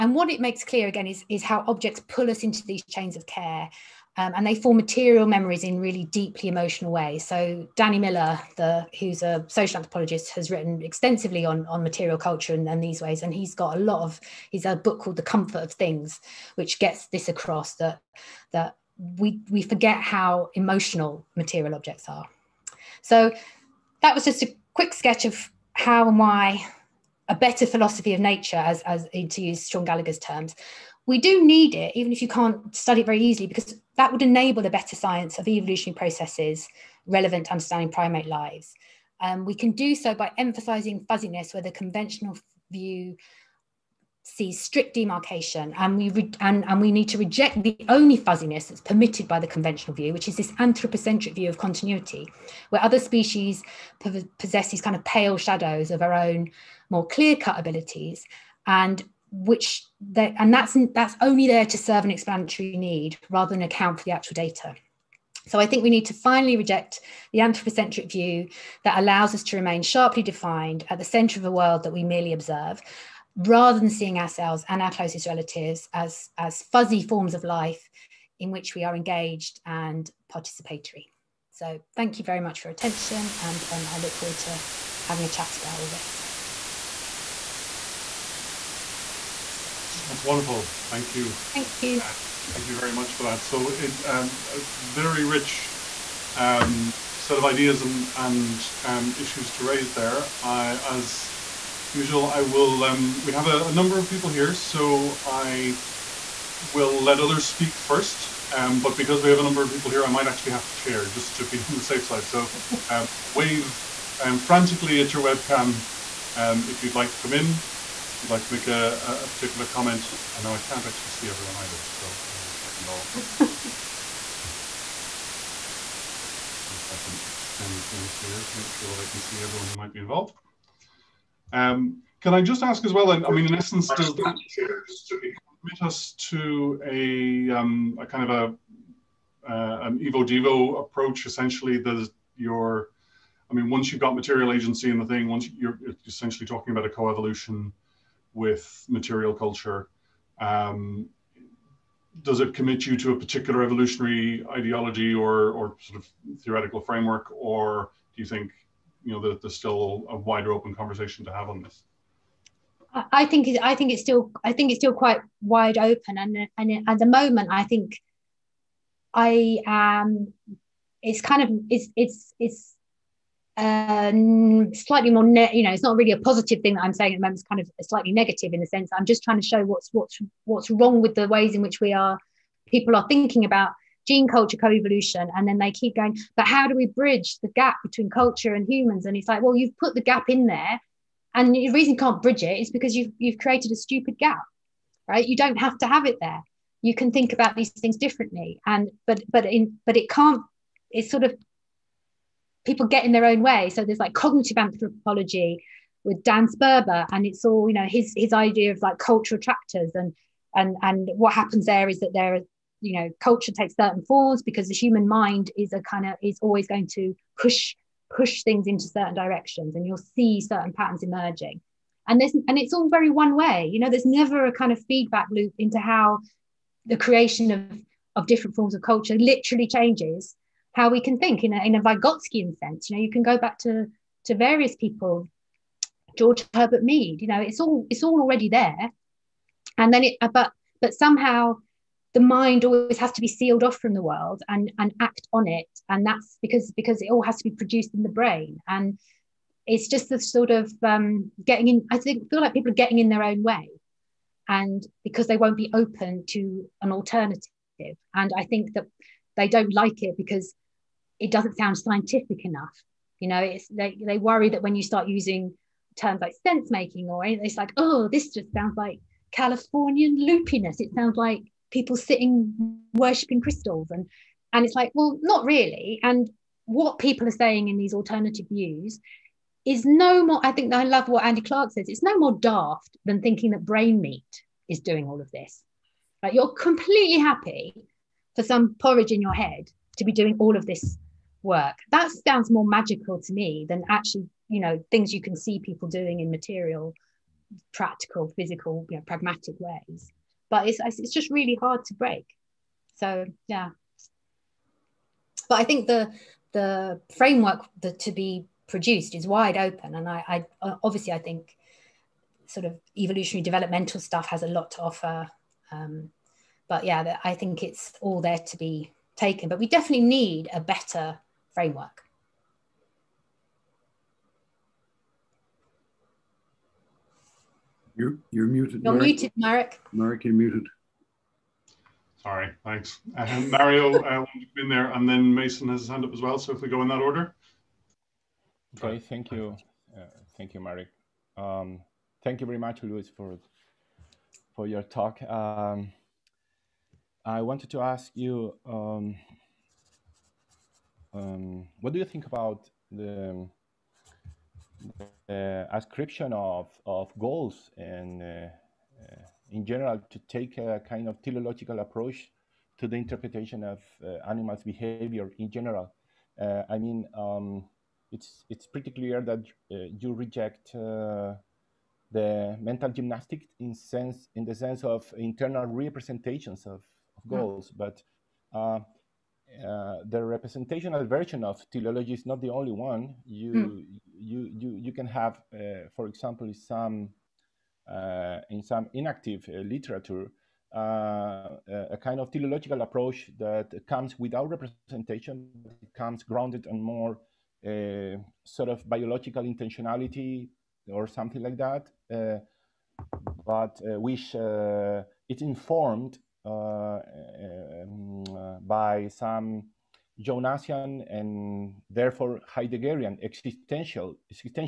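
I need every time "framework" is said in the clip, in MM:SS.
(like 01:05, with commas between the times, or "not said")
02:36, 05:07, 05:21.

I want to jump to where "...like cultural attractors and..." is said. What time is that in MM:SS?
03:28.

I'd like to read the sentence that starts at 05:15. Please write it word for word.
Um, but yeah, I think it's all there to be taken.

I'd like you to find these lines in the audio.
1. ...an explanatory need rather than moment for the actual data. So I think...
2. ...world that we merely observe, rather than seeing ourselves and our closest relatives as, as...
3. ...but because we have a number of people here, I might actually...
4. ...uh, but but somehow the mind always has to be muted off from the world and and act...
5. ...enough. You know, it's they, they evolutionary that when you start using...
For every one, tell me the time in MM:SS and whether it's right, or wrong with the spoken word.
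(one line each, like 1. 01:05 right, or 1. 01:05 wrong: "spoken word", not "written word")
1. 01:02 wrong: "account", not "moment"
2. 01:11 right
3. 01:48 right
4. 04:00 wrong: "sealed", not "muted"
5. 04:22 wrong: "worry", not "evolutionary".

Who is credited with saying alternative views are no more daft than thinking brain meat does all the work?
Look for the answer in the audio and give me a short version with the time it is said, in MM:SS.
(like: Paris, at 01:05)
Andy Clark, at 04:41.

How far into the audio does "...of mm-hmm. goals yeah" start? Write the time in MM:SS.
06:16.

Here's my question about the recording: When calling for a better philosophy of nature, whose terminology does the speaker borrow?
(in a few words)
Shaun Gallagher.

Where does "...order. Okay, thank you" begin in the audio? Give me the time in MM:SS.
05:37.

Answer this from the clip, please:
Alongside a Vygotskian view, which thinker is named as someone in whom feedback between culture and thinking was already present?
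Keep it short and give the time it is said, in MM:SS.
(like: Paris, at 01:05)
George Herbert Mead, at 03:56.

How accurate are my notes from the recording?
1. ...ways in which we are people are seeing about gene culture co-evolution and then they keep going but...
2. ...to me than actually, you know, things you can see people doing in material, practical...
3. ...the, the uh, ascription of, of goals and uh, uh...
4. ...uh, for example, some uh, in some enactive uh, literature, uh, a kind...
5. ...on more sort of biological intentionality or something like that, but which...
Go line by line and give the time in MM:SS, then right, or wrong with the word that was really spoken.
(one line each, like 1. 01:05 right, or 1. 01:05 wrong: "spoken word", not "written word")
1. 03:01 wrong: "thinking", not "seeing"
2. 04:53 right
3. 05:52 right
4. 06:25 right
5. 06:36 right.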